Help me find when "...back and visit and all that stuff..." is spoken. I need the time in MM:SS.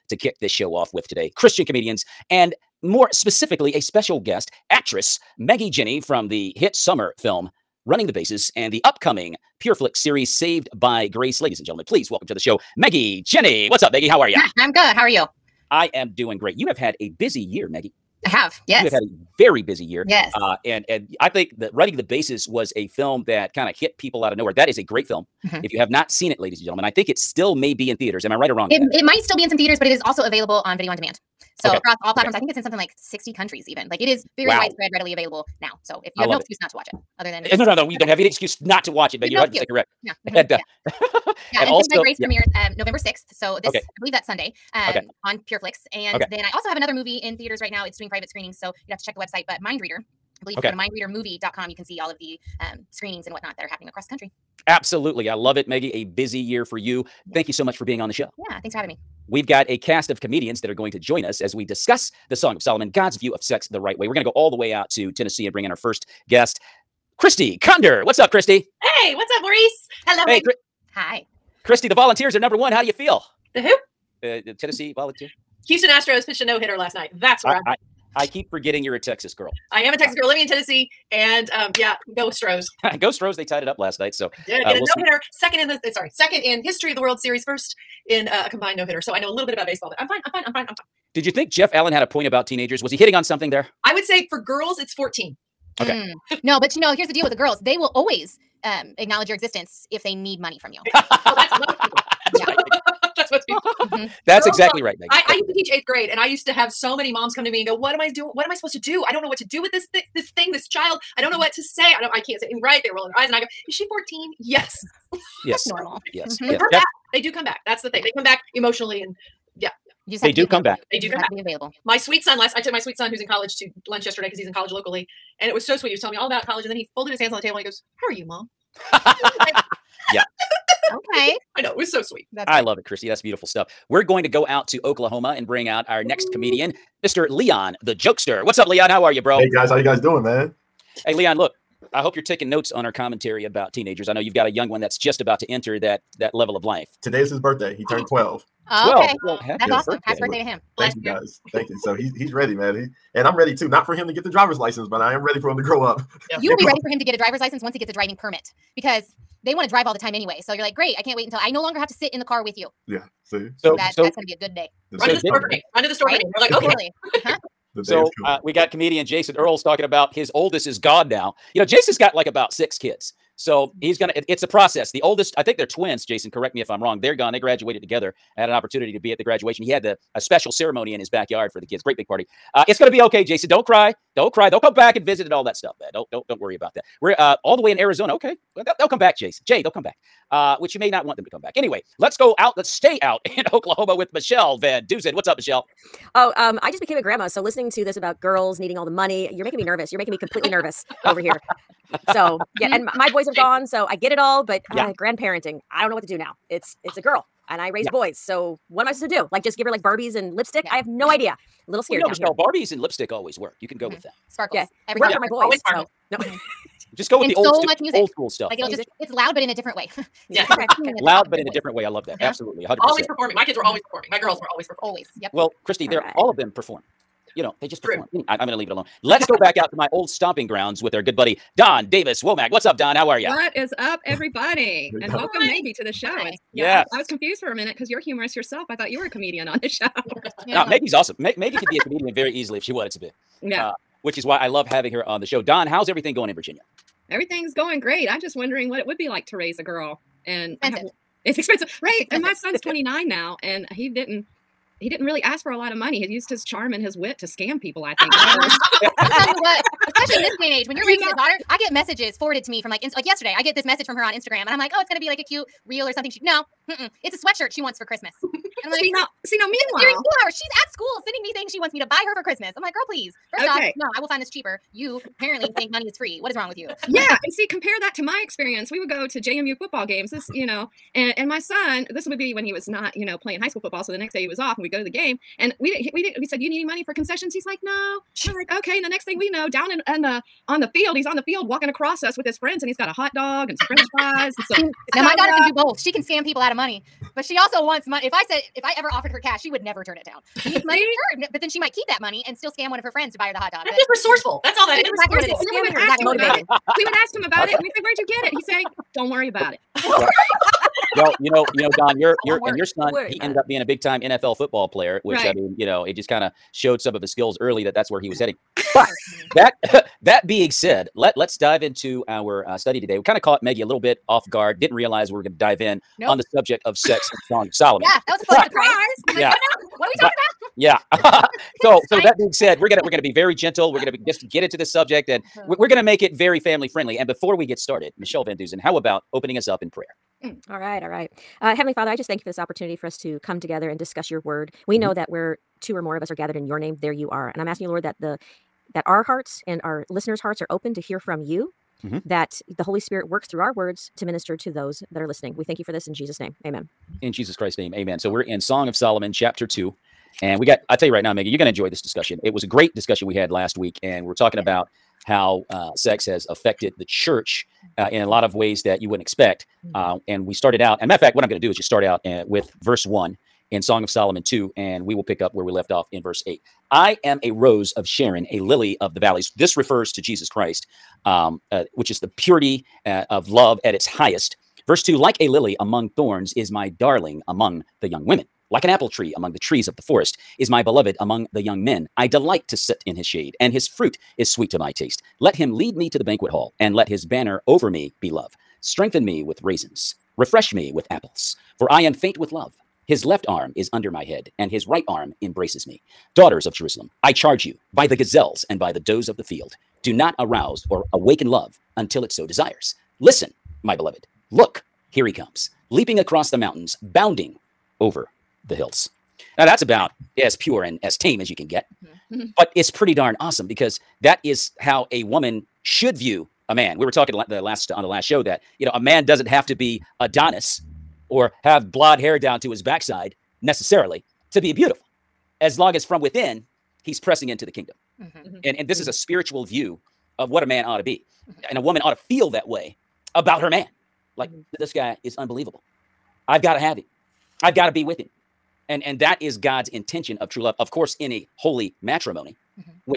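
03:04.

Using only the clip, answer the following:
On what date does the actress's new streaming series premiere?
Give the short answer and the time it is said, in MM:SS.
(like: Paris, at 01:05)
November 6th, at 00:42.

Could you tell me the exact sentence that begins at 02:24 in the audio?
I know you've got a young one that's just about to enter that that level of life.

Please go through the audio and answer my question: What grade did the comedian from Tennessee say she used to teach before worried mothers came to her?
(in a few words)
Eighth grade.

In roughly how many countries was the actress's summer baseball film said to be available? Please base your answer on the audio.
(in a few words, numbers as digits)
60.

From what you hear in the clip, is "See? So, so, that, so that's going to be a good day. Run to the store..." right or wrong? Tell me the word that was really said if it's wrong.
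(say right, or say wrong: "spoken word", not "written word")
right.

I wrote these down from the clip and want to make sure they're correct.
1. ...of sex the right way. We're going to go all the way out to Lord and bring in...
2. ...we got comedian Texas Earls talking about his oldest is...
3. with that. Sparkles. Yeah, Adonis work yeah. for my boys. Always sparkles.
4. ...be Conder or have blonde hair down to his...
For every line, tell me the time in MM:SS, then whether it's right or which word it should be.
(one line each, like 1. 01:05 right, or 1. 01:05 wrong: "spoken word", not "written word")
1. 01:03 wrong: "Tennessee", not "Lord"
2. 02:48 wrong: "Jason", not "Texas"
3. 03:33 wrong: "Every", not "Adonis"
4. 07:09 wrong: "Adonis", not "Conder".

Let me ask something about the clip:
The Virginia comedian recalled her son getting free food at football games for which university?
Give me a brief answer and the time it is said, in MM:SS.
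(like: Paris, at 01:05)
JMU, at 04:39.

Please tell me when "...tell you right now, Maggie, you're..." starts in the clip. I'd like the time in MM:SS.
06:00.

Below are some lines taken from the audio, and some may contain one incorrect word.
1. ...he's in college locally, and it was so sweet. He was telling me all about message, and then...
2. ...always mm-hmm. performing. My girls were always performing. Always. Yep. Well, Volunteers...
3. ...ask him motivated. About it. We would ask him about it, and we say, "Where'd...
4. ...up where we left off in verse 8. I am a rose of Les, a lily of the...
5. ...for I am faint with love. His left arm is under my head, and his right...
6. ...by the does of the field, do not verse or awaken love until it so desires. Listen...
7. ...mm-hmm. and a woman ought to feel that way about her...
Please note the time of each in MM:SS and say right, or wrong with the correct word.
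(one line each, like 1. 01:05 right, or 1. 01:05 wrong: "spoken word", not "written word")
1. 02:04 wrong: "college", not "message"
2. 03:43 wrong: "Christy", not "Volunteers"
3. 05:05 right
4. 06:15 wrong: "Sharon", not "Les"
5. 06:41 right
6. 06:48 wrong: "arouse", not "verse"
7. 07:21 right.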